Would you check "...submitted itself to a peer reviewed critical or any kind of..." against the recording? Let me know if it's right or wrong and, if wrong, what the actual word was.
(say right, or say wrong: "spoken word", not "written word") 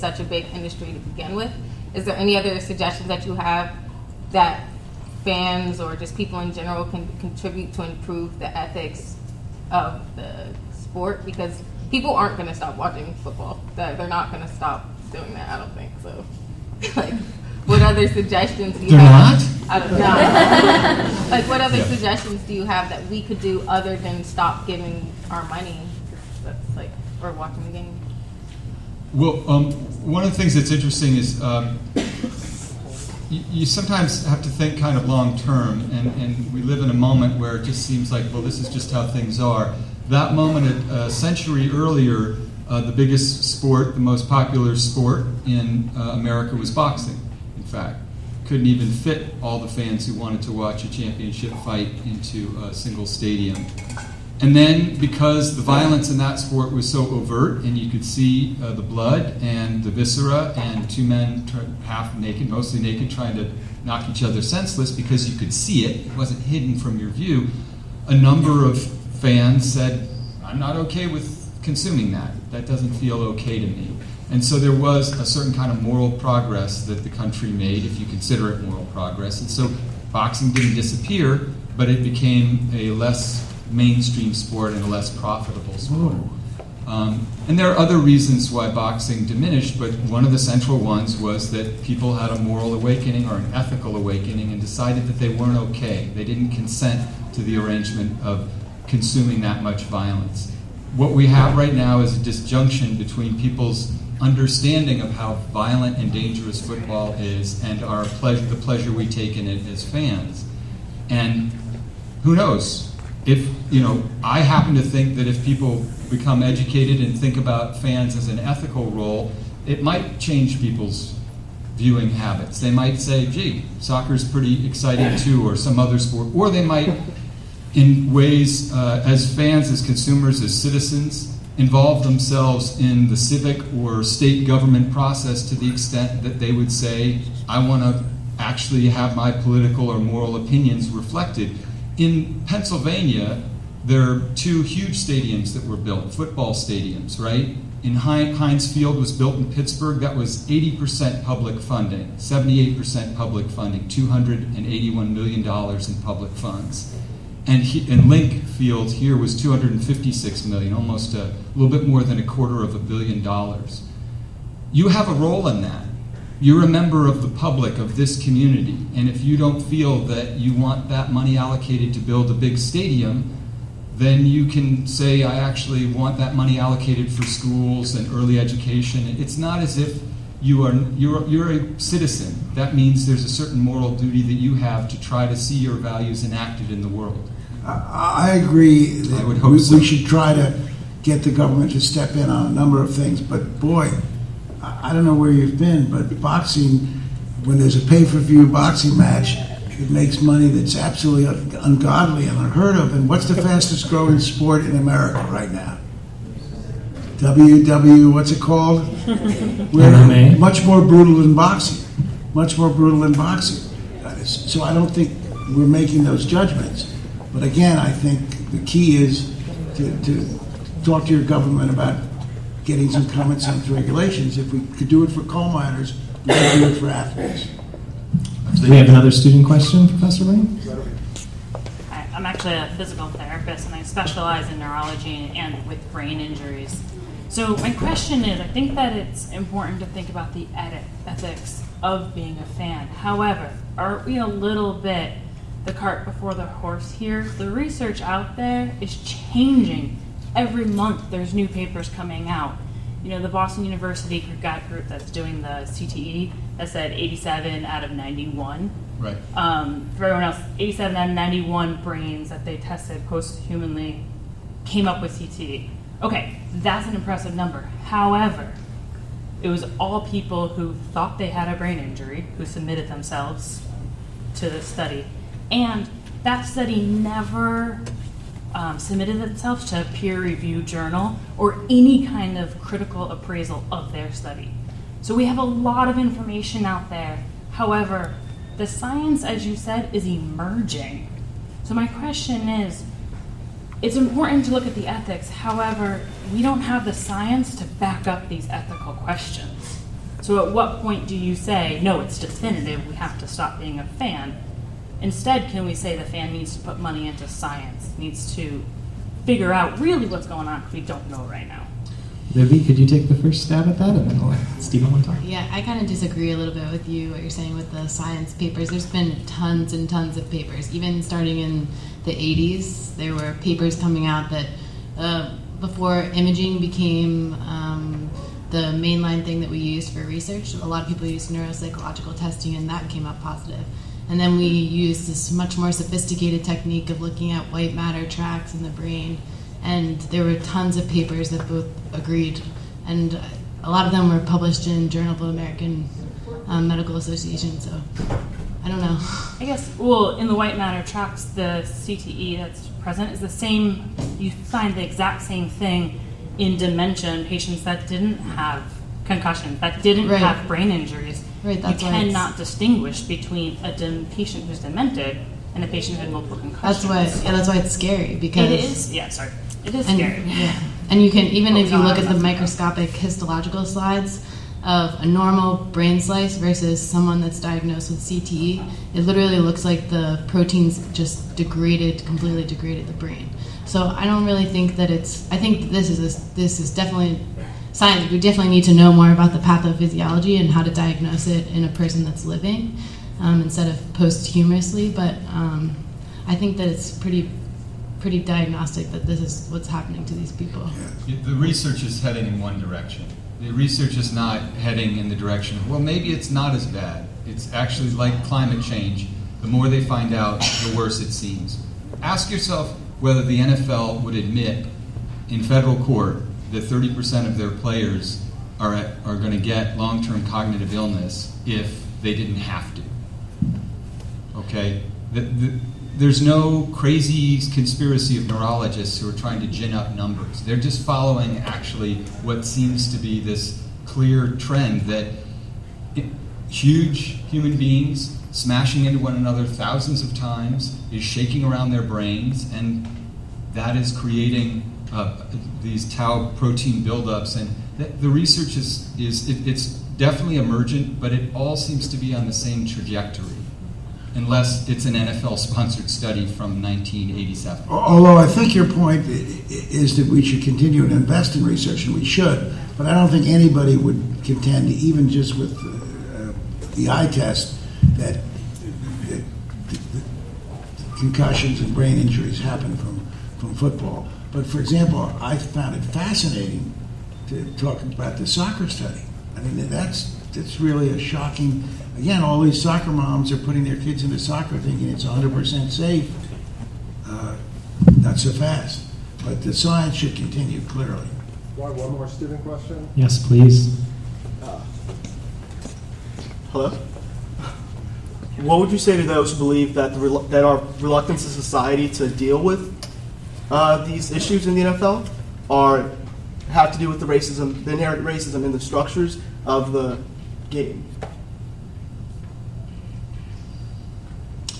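wrong: "journal", not "critical".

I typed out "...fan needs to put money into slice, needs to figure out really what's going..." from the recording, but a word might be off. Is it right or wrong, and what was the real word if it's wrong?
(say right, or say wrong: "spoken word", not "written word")
wrong: "science", not "slice".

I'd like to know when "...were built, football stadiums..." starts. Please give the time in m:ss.
2:25.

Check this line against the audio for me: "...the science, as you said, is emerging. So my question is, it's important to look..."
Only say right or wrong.
right.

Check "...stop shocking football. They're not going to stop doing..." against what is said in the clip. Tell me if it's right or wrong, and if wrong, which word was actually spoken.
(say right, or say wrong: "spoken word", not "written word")
wrong: "watching", not "shocking".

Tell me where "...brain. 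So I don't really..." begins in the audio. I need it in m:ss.
6:22.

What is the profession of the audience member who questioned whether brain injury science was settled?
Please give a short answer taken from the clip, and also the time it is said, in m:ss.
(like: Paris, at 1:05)
physical therapist, at 3:52.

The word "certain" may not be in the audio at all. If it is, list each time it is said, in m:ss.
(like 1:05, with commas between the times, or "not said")
1:15, 3:03.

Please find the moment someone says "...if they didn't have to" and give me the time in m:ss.
7:01.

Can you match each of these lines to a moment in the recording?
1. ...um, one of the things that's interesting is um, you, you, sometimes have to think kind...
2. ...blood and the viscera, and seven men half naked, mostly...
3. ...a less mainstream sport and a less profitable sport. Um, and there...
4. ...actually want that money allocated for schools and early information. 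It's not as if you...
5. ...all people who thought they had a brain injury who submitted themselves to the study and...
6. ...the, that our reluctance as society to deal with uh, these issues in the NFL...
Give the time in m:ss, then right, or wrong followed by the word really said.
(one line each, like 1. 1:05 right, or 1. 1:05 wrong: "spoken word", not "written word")
1. 0:29 right
2. 0:58 wrong: "two", not "seven"
3. 1:22 right
4. 2:55 wrong: "education", not "information"
5. 4:29 right
6. 8:19 right.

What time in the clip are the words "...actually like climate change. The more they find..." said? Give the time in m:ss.
6:47.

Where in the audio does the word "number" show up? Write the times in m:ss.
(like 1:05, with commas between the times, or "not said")
1:08, 3:12, 4:27, 7:09.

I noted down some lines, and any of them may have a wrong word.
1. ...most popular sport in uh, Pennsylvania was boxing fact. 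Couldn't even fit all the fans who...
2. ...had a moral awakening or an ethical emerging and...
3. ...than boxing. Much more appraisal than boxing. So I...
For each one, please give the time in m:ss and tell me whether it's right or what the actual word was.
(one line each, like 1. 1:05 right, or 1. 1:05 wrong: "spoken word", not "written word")
1. 0:44 wrong: "America", not "Pennsylvania"
2. 1:32 wrong: "awakening", not "emerging"
3. 3:31 wrong: "brutal", not "appraisal".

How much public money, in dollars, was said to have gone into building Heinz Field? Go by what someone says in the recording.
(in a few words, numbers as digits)
$281 million.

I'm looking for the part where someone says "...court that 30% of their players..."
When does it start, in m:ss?
6:55.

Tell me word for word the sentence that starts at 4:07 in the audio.
The research out there is changing.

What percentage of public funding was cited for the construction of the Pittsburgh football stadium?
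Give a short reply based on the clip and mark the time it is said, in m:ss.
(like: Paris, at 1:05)
78%, at 2:32.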